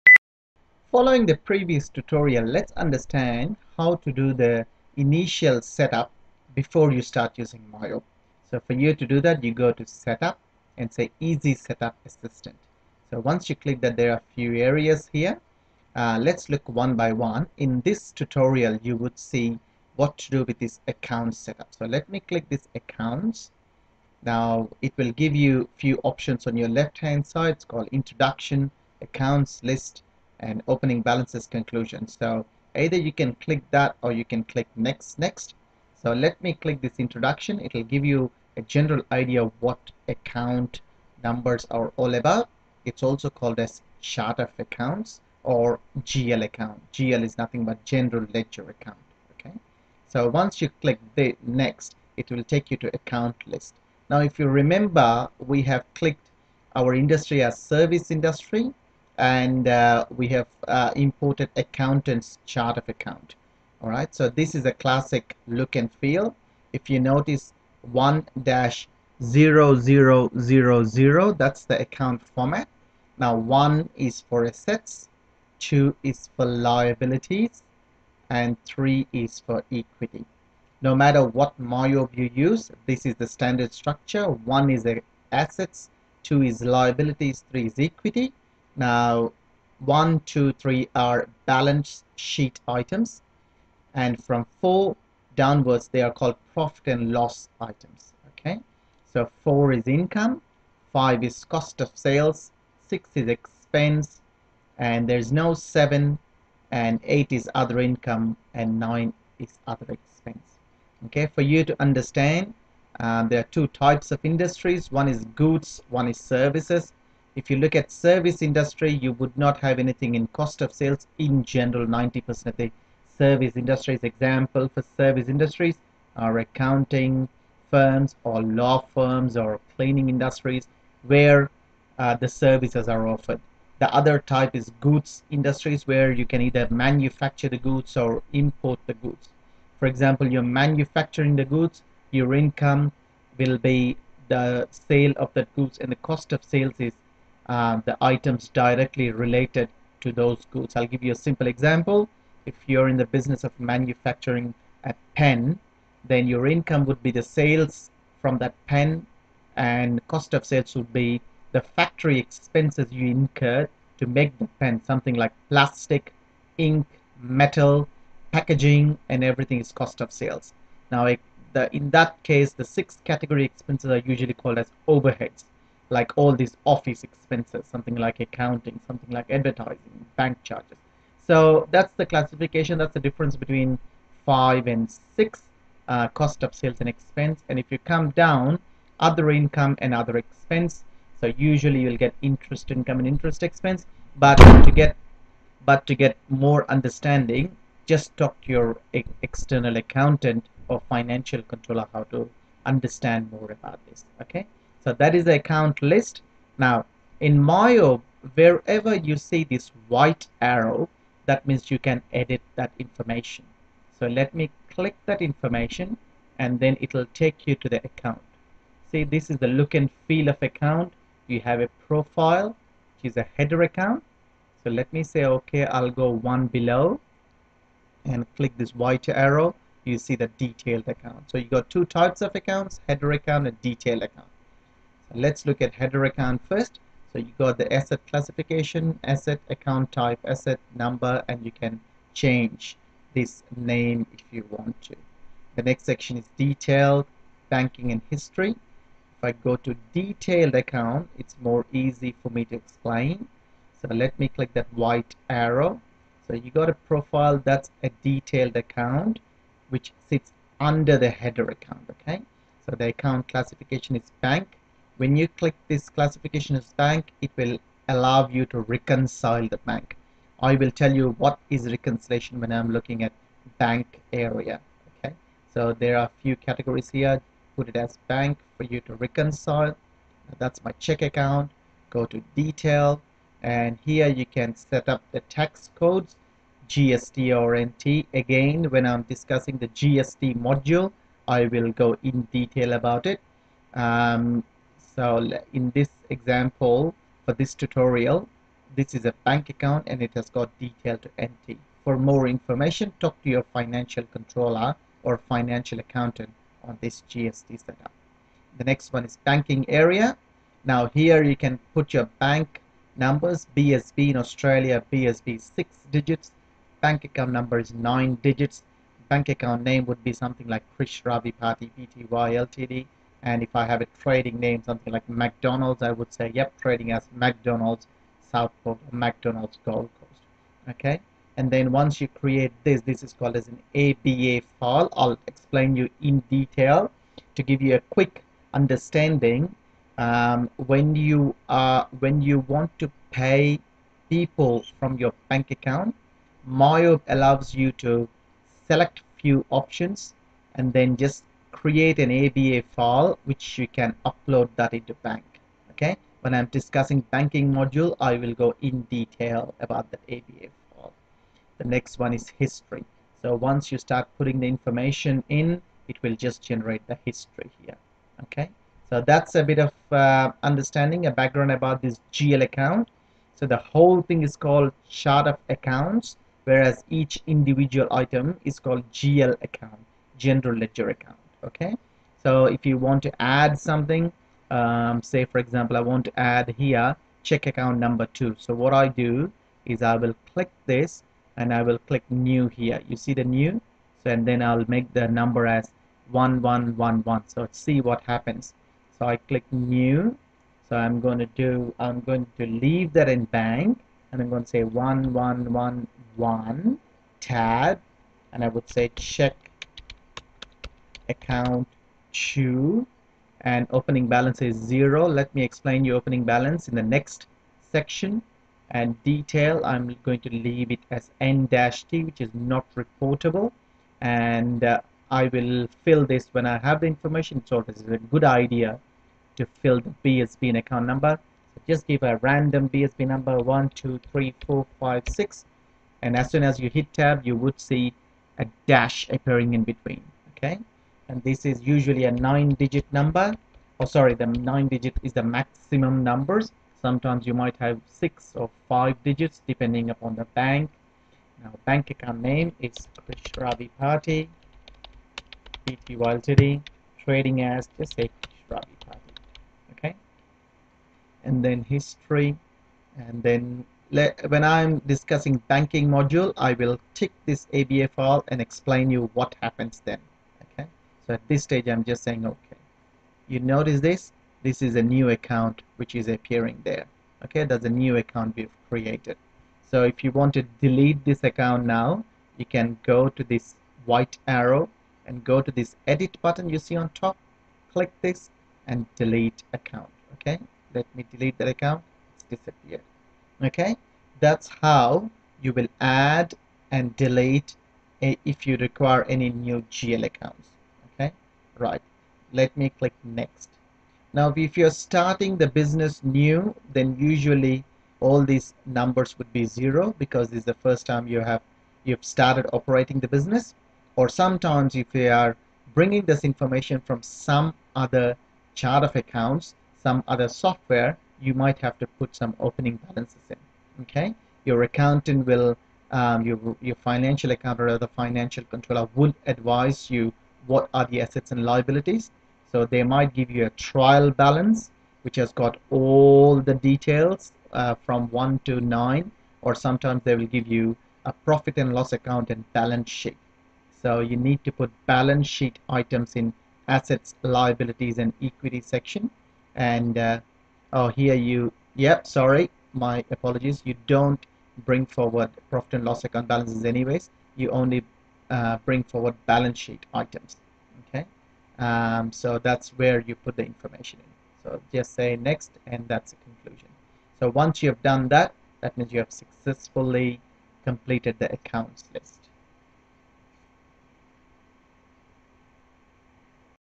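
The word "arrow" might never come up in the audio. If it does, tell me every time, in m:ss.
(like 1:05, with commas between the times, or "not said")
3:30, 3:49, 4:15, 8:04.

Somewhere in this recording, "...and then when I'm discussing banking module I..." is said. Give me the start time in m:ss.
7:43.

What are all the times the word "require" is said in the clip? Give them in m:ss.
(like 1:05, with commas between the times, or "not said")
8:18.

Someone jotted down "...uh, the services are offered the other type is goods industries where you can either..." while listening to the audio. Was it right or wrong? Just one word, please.
right.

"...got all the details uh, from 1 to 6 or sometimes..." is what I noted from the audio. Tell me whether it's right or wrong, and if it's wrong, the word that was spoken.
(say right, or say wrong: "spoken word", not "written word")
wrong: "9", not "6".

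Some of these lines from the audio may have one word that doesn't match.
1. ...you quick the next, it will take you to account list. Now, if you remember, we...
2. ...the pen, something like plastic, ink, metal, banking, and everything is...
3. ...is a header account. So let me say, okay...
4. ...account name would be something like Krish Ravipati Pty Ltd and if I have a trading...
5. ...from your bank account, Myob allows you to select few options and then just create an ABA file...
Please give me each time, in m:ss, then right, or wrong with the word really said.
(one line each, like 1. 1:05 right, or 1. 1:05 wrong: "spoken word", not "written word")
1. 0:50 wrong: "click", not "quick"
2. 2:44 wrong: "packaging", not "banking"
3. 3:43 right
4. 5:19 right
5. 5:44 right.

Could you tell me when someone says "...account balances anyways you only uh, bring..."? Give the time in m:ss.
9:16.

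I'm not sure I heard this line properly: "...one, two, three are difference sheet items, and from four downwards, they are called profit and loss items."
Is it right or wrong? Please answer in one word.
wrong.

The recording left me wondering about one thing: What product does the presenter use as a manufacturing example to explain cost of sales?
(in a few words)
a pen.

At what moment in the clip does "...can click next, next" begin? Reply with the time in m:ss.
0:34.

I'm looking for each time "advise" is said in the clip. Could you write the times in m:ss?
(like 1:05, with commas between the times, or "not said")
8:49.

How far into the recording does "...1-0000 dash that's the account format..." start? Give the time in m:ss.
1:07.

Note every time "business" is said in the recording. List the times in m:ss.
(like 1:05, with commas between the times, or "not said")
2:33, 8:25, 8:33.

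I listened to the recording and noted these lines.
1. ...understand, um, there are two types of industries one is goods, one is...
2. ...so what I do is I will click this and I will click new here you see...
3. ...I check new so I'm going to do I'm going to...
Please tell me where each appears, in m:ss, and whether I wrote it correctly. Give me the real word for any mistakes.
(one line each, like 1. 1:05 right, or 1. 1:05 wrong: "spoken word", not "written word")
1. 1:51 right
2. 6:28 right
3. 6:39 wrong: "click", not "check".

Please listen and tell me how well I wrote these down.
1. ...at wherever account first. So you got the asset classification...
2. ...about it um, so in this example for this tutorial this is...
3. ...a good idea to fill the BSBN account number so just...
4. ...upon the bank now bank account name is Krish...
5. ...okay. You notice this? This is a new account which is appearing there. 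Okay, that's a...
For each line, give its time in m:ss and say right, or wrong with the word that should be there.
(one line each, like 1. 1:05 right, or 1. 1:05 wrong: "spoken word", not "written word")
1. 3:55 wrong: "header", not "wherever"
2. 4:52 right
3. 7:07 right
4. 7:29 right
5. 7:52 right.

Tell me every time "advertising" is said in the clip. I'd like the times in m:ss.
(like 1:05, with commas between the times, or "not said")
2:59.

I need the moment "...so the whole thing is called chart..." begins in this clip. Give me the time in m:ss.
6:13.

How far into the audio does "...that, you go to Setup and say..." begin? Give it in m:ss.
0:09.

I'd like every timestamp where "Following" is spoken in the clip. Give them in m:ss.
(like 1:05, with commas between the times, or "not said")
0:00.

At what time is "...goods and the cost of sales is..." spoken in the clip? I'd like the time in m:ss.
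2:25.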